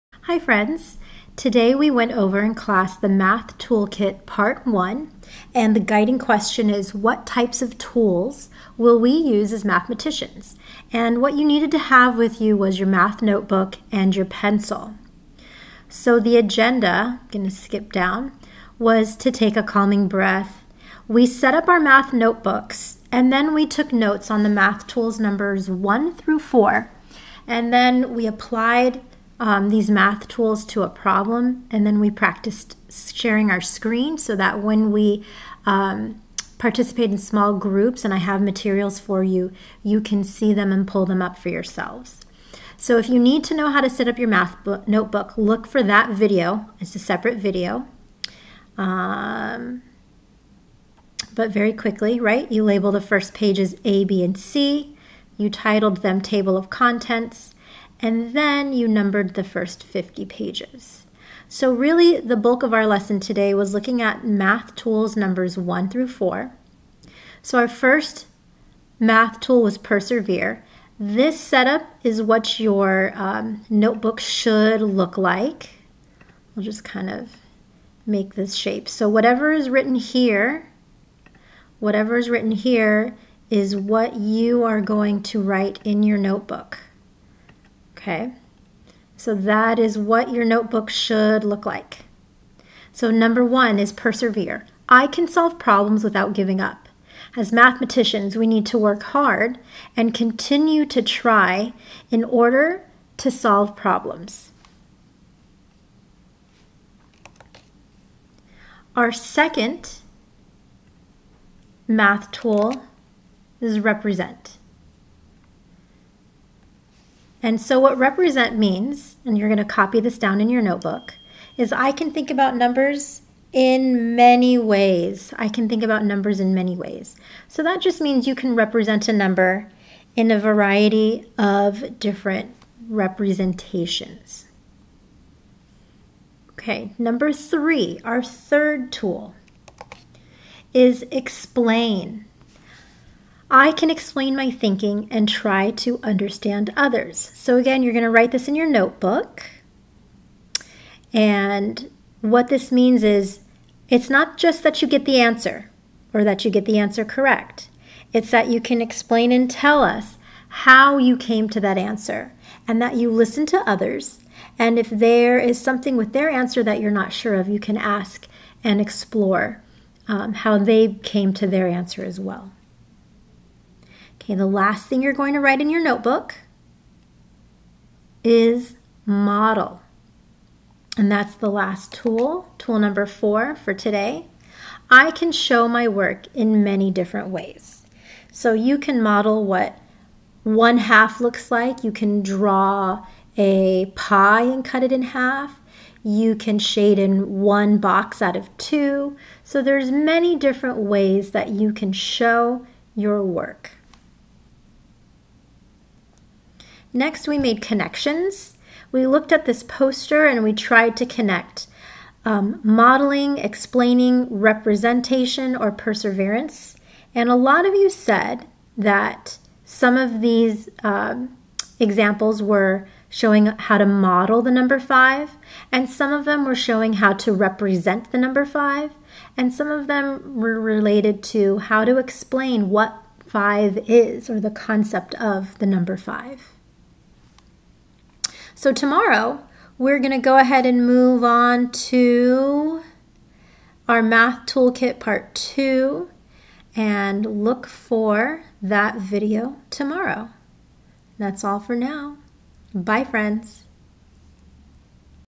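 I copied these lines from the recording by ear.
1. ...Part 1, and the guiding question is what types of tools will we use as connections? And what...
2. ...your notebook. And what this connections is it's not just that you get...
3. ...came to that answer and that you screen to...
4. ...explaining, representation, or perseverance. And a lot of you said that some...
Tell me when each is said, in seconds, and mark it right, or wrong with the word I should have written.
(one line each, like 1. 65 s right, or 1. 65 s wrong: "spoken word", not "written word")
1. 4 s wrong: "mathematicians", not "connections"
2. 148 s wrong: "means", not "connections"
3. 161 s wrong: "listen", not "screen"
4. 213 s right.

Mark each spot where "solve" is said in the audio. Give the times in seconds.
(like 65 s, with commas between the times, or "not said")
95 s, 103 s.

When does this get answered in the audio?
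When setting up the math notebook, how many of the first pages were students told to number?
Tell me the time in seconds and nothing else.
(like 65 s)
59 s.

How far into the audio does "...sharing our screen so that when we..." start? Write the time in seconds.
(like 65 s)
33 s.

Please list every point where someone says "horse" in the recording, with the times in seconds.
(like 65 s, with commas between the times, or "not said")
not said.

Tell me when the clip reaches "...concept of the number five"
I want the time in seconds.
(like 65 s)
234 s.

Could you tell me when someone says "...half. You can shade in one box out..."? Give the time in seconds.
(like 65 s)
195 s.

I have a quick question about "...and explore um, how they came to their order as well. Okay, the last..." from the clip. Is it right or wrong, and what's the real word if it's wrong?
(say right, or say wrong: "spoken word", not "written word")
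wrong: "answer", not "order".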